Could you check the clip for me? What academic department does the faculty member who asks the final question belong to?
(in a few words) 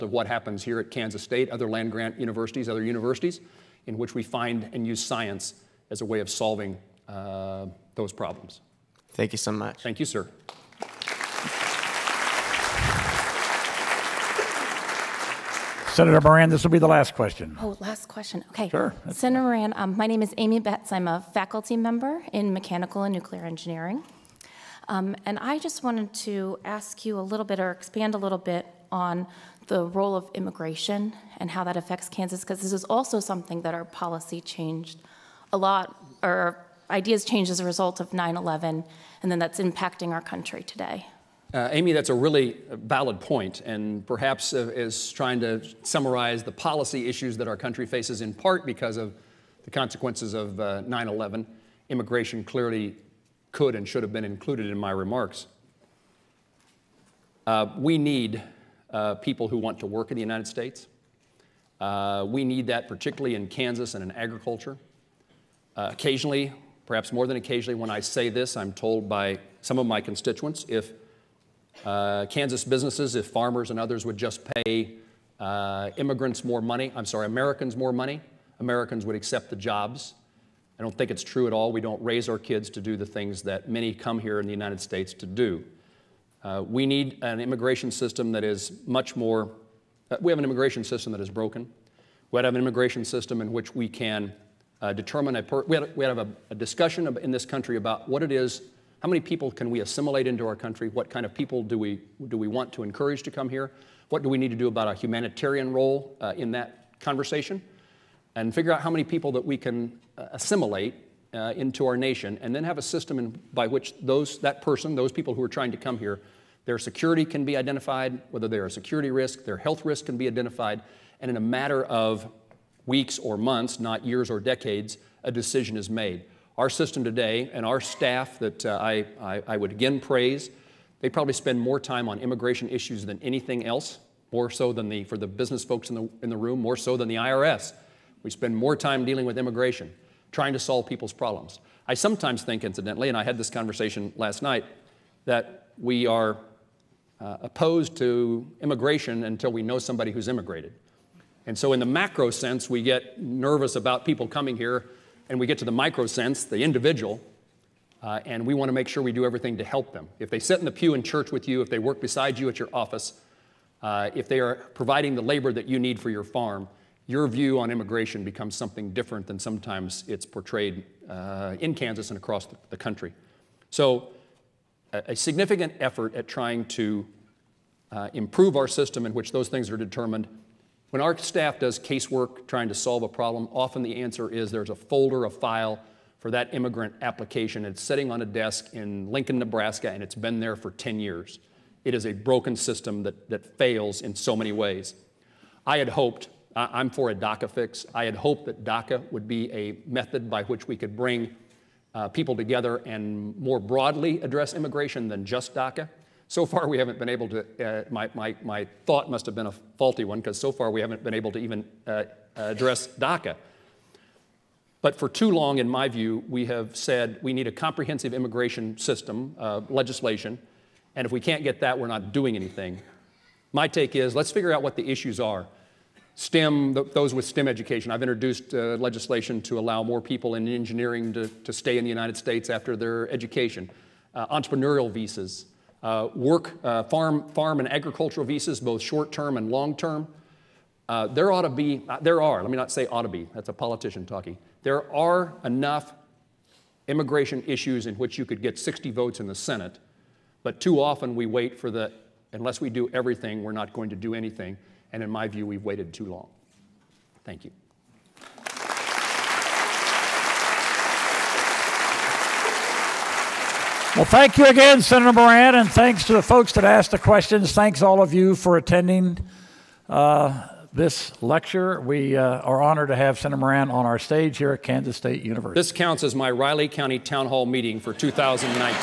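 Mechanical and nuclear engineering.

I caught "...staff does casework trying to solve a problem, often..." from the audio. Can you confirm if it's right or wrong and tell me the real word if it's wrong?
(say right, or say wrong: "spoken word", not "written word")
right.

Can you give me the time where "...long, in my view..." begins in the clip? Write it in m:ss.
3:35.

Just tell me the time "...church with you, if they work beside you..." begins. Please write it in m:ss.
2:41.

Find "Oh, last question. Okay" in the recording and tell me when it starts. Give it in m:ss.
0:17.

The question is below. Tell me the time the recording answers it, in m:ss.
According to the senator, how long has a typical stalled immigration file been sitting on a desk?
3:10.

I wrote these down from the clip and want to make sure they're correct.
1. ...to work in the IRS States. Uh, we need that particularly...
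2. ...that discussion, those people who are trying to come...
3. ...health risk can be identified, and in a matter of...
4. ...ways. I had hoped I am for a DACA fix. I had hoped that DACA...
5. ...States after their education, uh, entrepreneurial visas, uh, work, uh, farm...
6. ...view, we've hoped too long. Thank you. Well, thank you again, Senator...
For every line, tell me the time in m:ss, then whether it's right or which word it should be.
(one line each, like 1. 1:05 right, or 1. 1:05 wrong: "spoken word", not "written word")
1. 0:59 wrong: "United", not "IRS"
2. 1:54 wrong: "person", not "discussion"
3. 1:59 right
4. 3:14 right
5. 3:52 right
6. 4:15 wrong: "waited", not "hoped".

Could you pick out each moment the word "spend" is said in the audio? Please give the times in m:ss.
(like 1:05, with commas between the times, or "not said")
2:11, 2:18.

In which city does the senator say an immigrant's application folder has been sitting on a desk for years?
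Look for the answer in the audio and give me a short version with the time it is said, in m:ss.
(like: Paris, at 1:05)
Lincoln, Nebraska, at 3:09.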